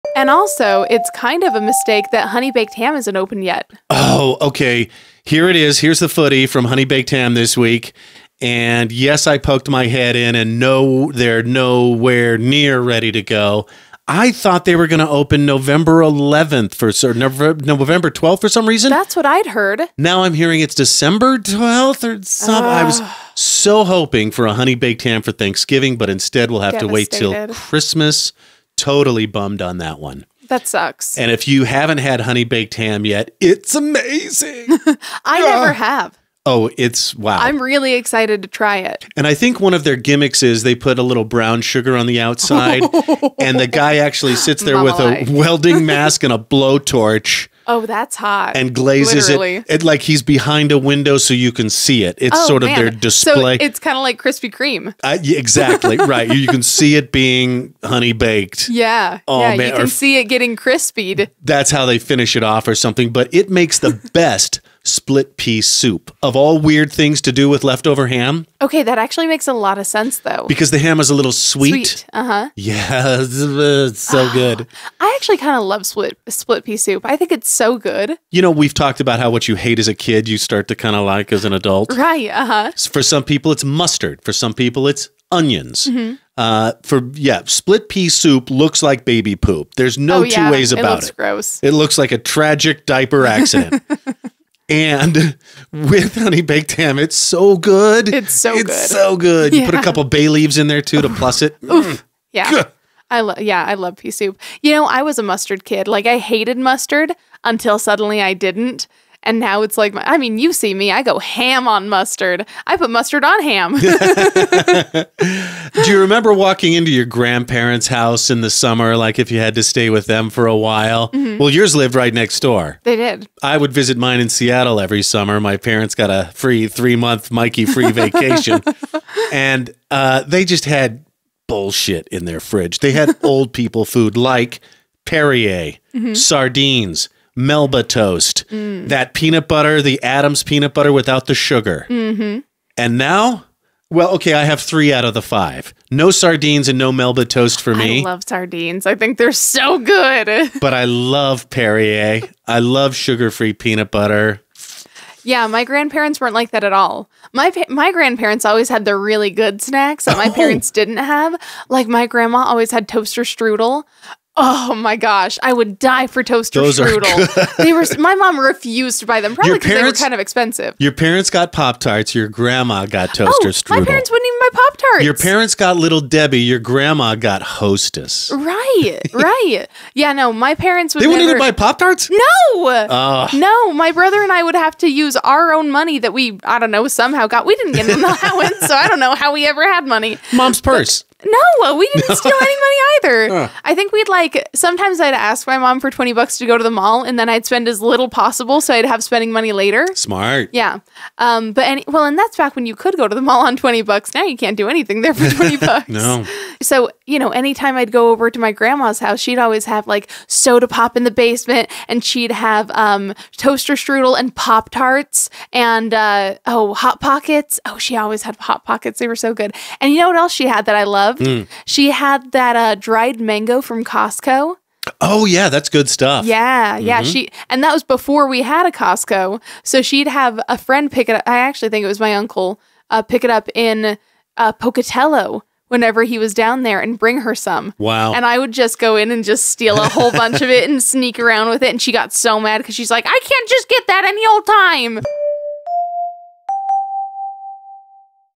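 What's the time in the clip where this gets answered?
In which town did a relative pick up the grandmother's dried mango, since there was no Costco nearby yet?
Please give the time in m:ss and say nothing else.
3:54.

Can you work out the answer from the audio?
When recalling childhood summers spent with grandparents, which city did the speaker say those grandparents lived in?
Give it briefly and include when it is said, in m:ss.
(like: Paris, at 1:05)
Seattle, at 2:04.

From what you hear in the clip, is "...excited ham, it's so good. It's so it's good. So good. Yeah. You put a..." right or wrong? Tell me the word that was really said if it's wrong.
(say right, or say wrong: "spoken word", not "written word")
wrong: "baked", not "excited".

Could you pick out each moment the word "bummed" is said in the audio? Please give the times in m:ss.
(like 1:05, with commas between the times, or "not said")
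0:29.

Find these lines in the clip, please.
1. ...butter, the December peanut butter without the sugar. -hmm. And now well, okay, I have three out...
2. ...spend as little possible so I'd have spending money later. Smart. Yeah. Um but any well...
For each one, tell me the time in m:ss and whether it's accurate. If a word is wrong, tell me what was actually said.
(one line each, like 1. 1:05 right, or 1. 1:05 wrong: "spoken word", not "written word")
1. 2:19 wrong: "Adams", not "December"
2. 3:17 right.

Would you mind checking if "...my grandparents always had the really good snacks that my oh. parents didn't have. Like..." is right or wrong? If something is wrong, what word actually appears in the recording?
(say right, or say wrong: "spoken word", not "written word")
right.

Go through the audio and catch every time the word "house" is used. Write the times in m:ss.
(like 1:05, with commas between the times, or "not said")
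1:57, 3:28.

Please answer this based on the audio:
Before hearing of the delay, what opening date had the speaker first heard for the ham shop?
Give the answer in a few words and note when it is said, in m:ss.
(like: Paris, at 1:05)
November 11th, at 0:15.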